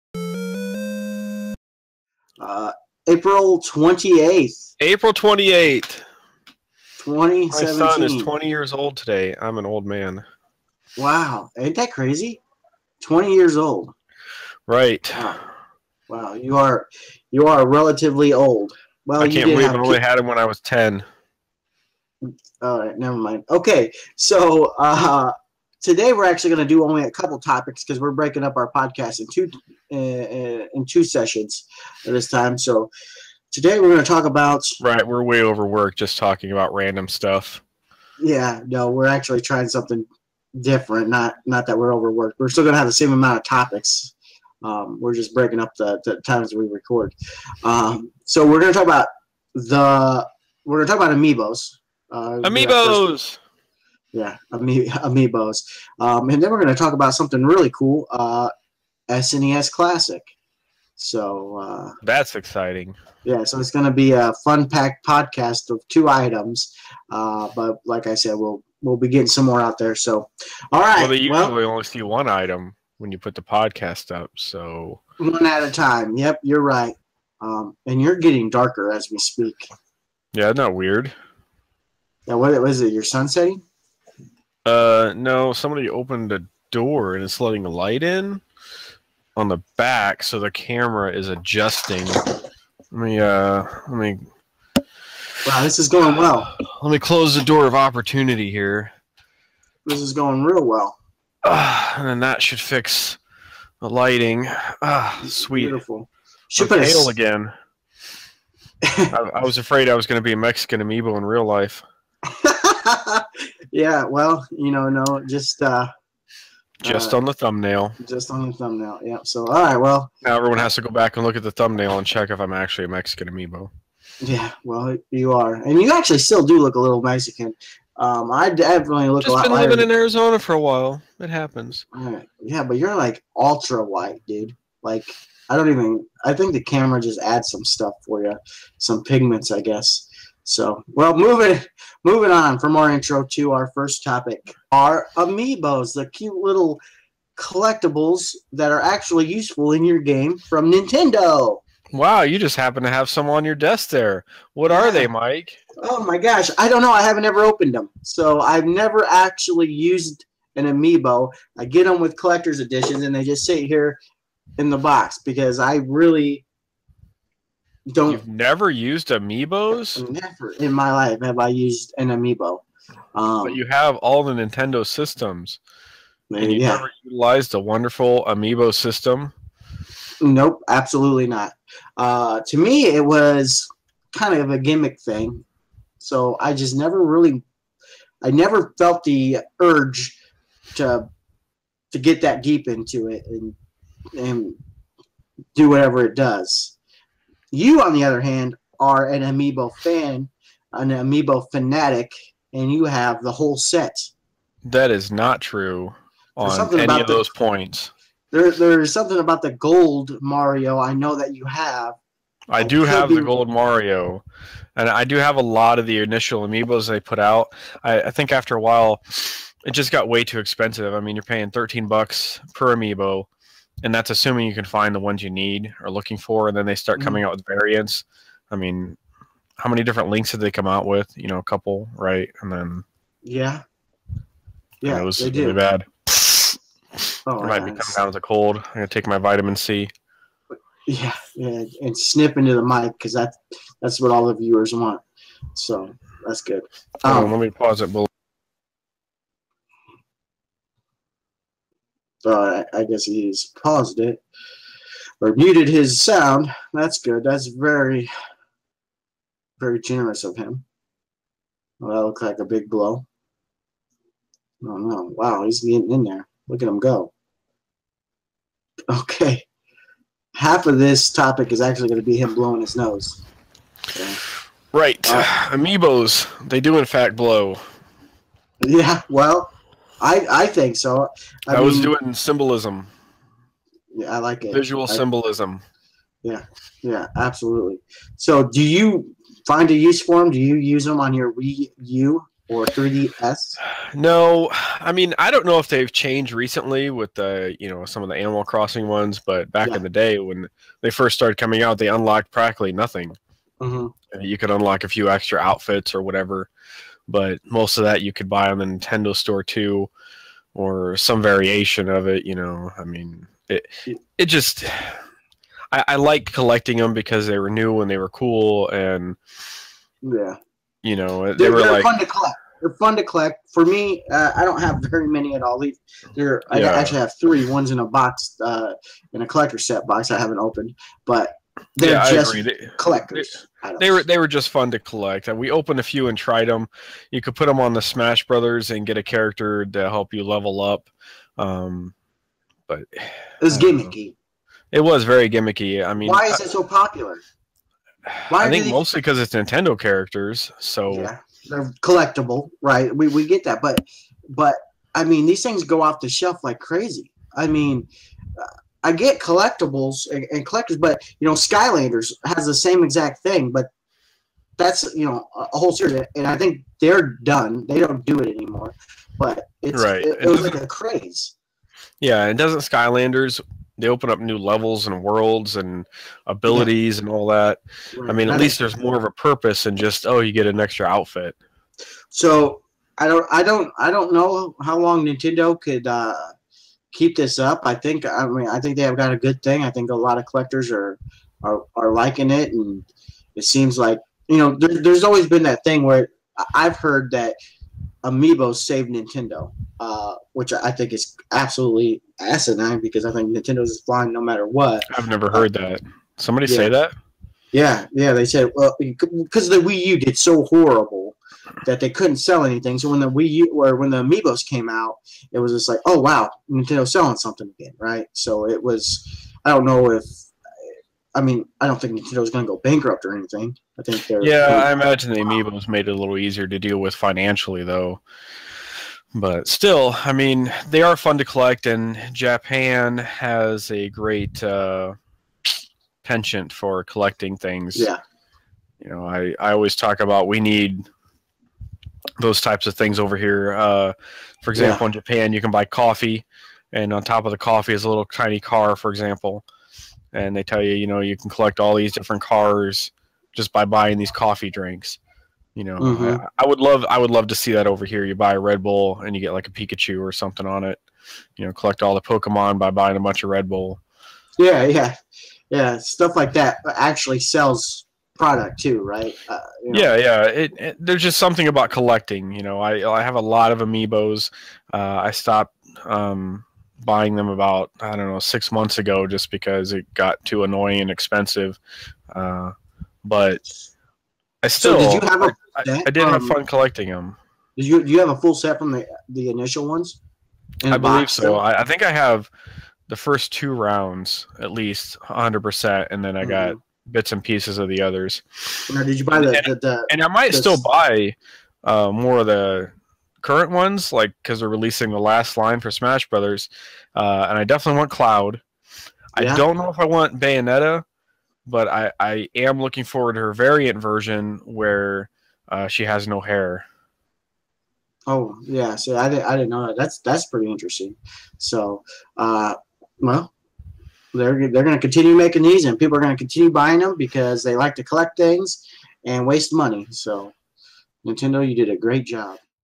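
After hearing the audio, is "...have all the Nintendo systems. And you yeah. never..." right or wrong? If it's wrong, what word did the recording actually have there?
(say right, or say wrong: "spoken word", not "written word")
right.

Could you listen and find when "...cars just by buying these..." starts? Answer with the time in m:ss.
7:32.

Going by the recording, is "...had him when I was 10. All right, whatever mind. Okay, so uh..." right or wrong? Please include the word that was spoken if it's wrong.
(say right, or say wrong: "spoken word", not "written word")
wrong: "never", not "whatever".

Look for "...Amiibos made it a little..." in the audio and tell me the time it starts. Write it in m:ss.
7:05.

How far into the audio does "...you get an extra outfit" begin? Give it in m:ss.
6:20.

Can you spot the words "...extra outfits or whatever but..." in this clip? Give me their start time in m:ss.
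5:05.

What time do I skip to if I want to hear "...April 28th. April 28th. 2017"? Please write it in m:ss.
0:03.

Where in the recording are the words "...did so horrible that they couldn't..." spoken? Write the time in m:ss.
6:49.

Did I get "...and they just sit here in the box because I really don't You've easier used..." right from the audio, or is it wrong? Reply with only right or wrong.
wrong.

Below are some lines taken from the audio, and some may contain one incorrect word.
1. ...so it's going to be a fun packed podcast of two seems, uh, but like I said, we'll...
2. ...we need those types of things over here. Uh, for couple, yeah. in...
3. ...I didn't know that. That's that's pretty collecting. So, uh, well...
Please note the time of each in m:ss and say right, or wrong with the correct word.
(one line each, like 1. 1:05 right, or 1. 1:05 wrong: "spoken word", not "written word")
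1. 1:03 wrong: "items", not "seems"
2. 7:20 wrong: "example", not "couple"
3. 8:39 wrong: "interesting", not "collecting".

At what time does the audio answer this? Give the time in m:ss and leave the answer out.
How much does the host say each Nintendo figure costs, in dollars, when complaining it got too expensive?
3:41.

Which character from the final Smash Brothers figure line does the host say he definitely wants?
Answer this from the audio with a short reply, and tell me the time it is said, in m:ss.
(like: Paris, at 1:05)
Cloud, at 8:27.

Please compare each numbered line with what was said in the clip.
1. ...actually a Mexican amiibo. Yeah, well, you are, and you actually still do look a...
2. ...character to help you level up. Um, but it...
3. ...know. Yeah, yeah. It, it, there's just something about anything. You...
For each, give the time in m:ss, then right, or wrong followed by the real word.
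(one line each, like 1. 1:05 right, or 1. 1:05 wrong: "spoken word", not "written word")
1. 2:02 right
2. 5:39 right
3. 7:49 wrong: "collecting", not "anything".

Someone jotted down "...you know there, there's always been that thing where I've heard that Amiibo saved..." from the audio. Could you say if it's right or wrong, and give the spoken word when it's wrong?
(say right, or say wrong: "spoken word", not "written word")
right.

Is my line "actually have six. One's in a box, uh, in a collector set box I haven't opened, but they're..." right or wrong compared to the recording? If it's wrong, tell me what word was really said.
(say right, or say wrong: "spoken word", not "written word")
wrong: "three", not "six".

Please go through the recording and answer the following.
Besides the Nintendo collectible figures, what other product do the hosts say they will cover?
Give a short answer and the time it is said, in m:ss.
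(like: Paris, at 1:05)
SNES Classic, at 0:59.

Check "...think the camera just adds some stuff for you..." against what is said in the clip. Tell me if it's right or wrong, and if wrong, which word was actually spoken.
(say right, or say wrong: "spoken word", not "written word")
right.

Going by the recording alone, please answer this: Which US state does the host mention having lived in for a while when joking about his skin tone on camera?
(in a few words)
Arizona.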